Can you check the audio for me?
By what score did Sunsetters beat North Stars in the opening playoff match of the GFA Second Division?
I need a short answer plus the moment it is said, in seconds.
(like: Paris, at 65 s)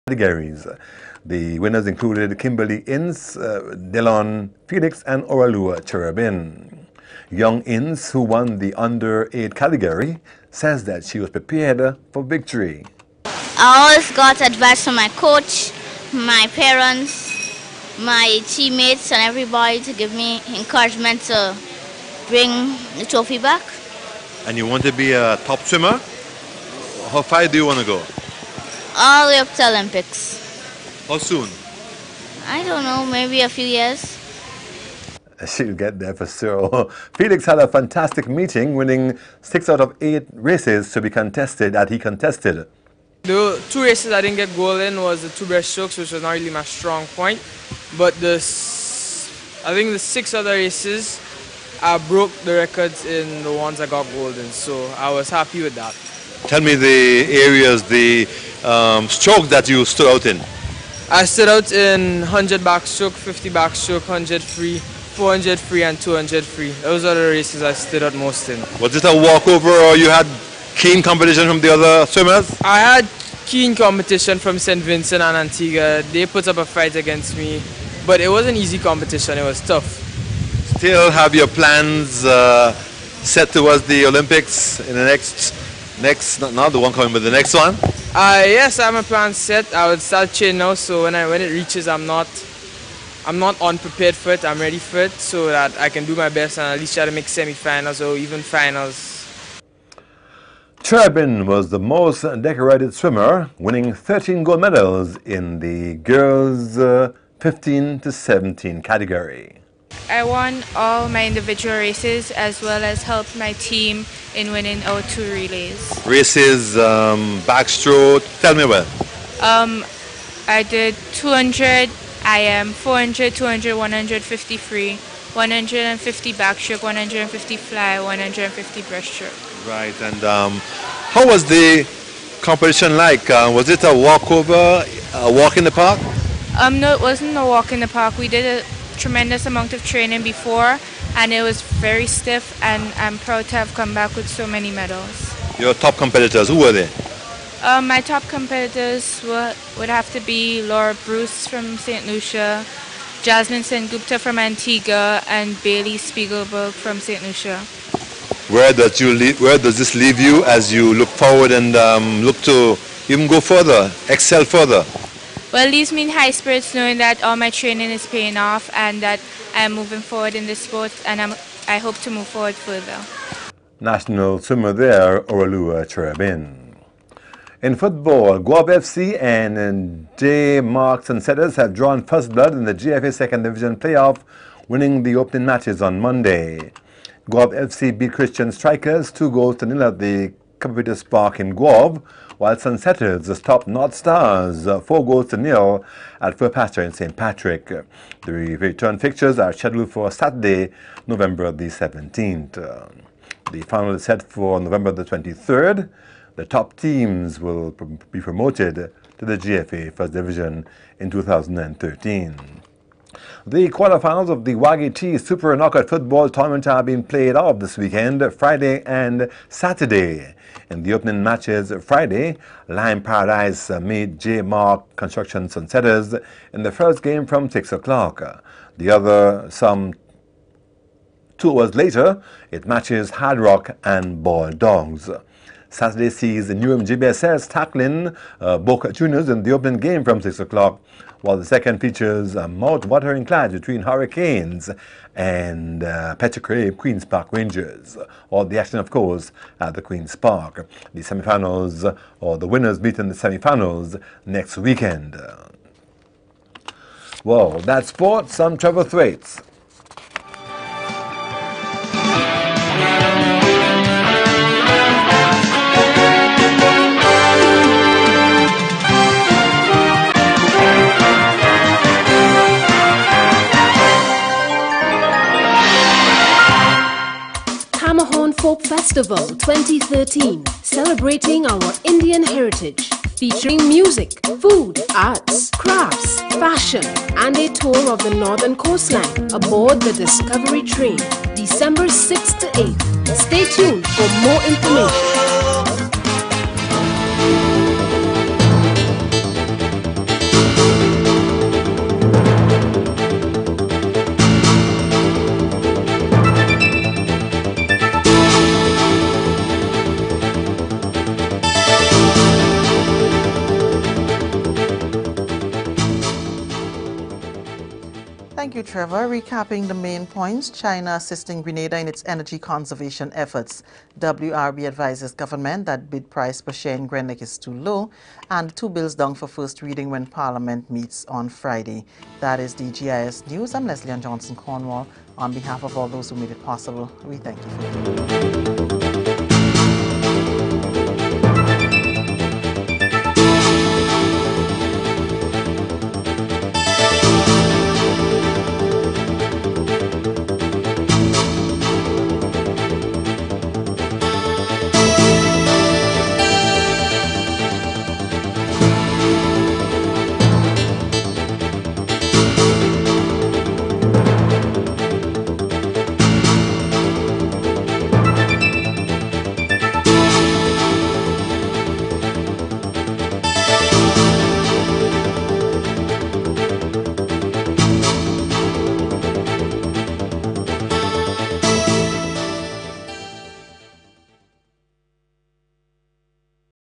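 4-0, at 194 s.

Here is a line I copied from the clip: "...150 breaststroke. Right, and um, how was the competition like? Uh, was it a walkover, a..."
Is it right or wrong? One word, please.
right.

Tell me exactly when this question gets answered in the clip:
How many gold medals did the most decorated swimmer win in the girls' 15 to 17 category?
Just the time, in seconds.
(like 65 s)
103 s.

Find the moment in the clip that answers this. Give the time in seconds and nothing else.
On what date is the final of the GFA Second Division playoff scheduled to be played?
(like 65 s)
204 s.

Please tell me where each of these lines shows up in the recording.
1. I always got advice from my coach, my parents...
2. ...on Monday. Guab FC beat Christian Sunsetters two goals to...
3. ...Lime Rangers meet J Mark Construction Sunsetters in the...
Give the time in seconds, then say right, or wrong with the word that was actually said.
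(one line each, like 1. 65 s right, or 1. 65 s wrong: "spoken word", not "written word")
1. 13 s right
2. 185 s wrong: "Strikers", not "Sunsetters"
3. 222 s wrong: "Paradise", not "Rangers".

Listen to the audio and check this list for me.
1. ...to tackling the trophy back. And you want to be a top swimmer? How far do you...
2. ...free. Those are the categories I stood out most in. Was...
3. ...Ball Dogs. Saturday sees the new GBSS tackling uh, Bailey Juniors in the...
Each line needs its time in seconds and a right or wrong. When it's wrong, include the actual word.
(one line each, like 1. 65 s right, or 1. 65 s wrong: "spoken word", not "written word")
1. 21 s wrong: "bring", not "tackling"
2. 66 s wrong: "races", not "categories"
3. 234 s wrong: "Boca", not "Bailey".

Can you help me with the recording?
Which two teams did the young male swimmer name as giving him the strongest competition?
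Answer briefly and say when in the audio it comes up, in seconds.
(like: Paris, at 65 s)
St. Vincent and Antigua, at 74 s.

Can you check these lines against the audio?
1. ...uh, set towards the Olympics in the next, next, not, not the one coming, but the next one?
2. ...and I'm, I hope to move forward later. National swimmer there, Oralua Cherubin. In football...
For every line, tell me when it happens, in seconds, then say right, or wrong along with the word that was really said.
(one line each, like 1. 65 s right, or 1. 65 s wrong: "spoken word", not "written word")
1. 82 s right
2. 171 s wrong: "further", not "later".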